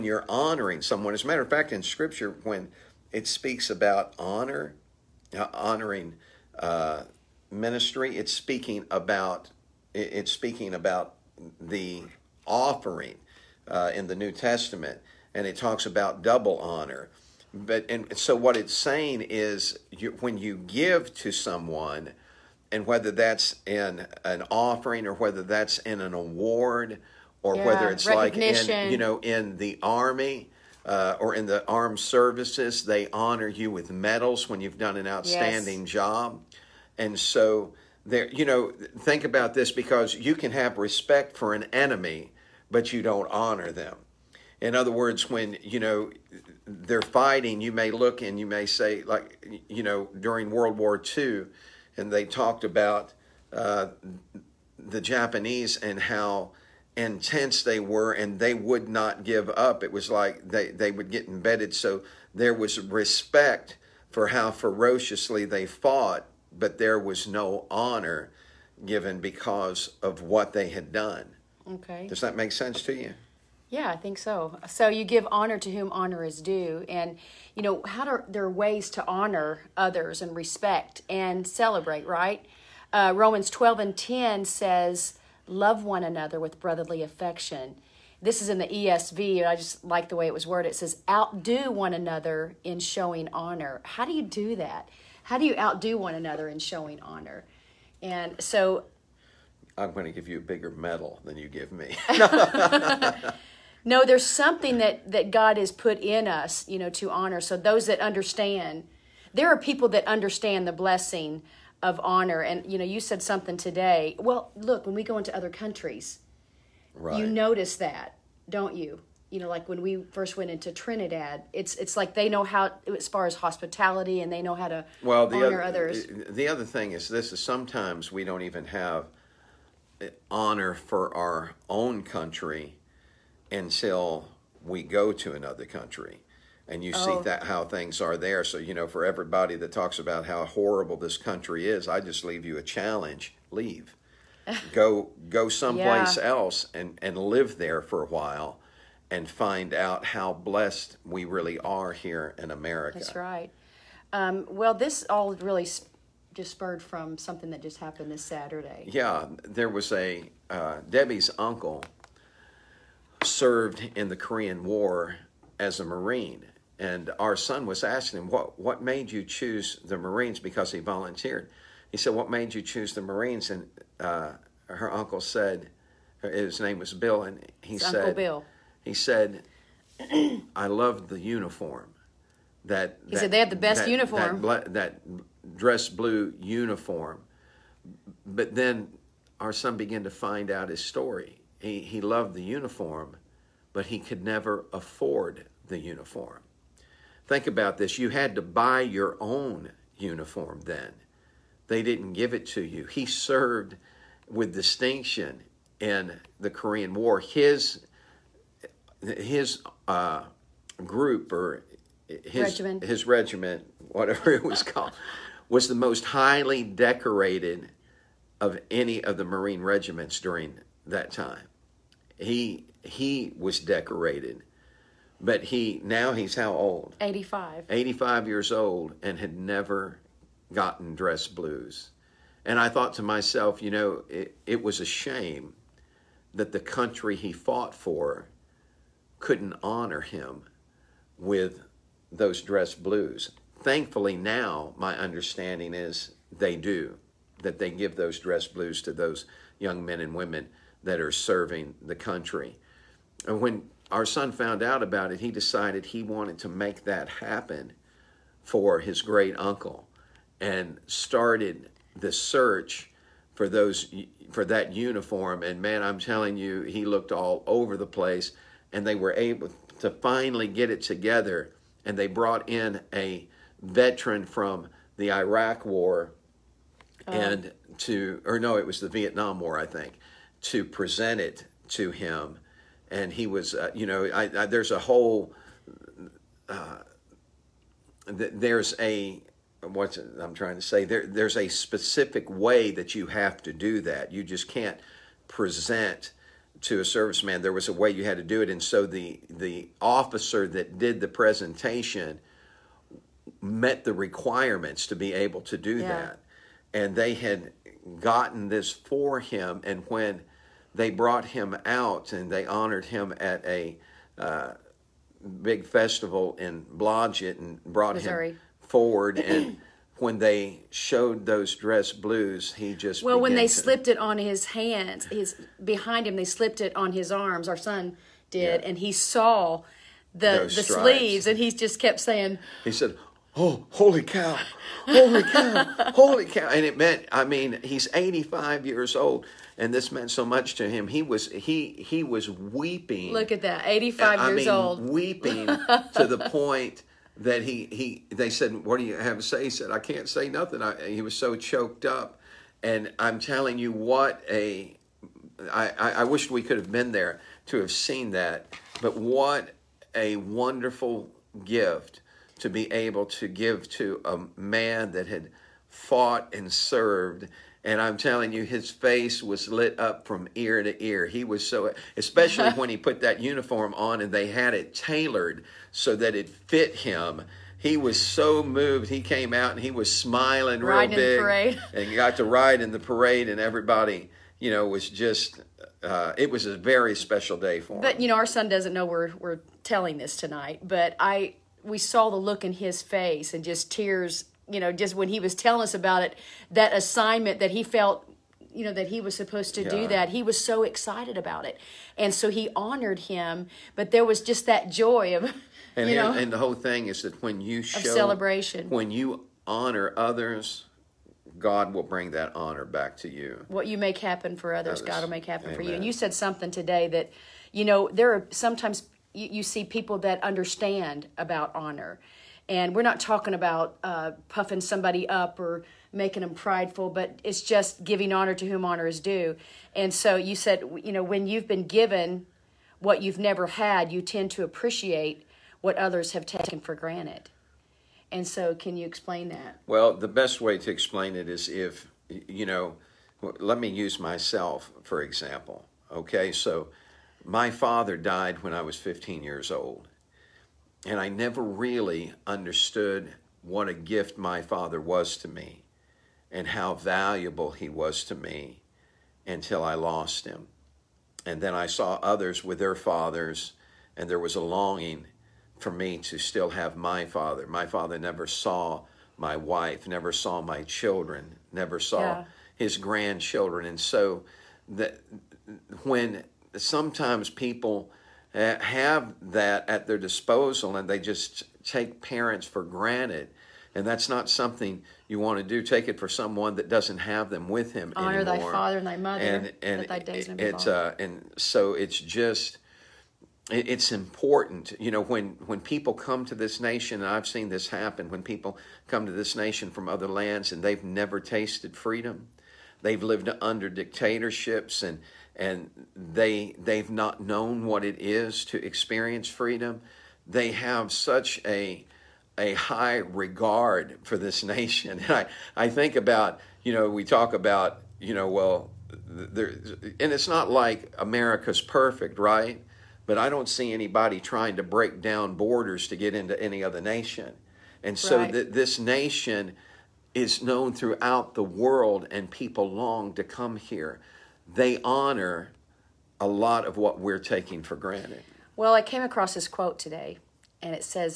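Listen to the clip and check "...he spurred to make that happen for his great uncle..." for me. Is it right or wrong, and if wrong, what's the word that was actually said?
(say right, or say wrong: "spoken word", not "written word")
wrong: "wanted", not "spurred".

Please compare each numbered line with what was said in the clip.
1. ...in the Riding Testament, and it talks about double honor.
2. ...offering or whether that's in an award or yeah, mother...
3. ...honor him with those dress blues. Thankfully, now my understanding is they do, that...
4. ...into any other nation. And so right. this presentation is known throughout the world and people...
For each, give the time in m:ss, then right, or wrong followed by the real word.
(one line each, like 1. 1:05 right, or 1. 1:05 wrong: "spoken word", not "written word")
1. 0:13 wrong: "New", not "Riding"
2. 0:24 wrong: "whether", not "mother"
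3. 3:59 right
4. 8:46 wrong: "nation", not "presentation".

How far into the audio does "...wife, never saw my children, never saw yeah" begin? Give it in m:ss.
7:49.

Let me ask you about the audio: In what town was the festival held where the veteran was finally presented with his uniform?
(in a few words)
Blodgett.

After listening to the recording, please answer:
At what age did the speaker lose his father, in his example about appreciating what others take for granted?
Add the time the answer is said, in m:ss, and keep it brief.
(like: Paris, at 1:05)
15, at 7:28.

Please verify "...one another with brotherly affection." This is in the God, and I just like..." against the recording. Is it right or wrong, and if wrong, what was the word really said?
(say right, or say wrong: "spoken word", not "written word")
wrong: "ESV", not "God".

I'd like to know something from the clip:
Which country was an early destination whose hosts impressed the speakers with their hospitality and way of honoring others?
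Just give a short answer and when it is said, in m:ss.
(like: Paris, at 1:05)
Trinidad, at 2:00.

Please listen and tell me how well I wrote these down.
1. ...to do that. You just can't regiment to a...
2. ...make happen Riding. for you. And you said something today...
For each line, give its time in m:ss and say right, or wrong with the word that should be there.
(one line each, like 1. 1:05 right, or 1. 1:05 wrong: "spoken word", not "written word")
1. 4:53 wrong: "present", not "regiment"
2. 6:55 wrong: "Amen", not "Riding".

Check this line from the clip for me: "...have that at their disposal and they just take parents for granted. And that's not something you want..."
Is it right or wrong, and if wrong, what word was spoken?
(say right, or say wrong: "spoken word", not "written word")
right.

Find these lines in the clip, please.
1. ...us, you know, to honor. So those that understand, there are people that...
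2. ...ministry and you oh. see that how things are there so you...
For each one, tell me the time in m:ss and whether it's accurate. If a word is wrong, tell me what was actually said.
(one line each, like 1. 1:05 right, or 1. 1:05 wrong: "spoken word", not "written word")
1. 1:46 right
2. 2:15 wrong: "country", not "ministry".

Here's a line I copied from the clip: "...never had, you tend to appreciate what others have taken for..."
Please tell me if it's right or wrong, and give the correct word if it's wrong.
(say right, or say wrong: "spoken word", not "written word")
right.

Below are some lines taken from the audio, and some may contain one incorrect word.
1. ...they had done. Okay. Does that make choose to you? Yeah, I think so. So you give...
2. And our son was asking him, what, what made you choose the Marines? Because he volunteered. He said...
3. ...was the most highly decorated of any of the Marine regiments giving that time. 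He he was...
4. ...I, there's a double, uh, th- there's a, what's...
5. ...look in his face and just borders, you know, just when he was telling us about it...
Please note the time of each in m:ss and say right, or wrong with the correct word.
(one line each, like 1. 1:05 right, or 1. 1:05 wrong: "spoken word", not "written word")
1. 1:10 wrong: "sense", not "choose"
2. 2:46 right
3. 3:35 wrong: "during", not "giving"
4. 4:44 wrong: "whole", not "double"
5. 6:32 wrong: "tears", not "borders".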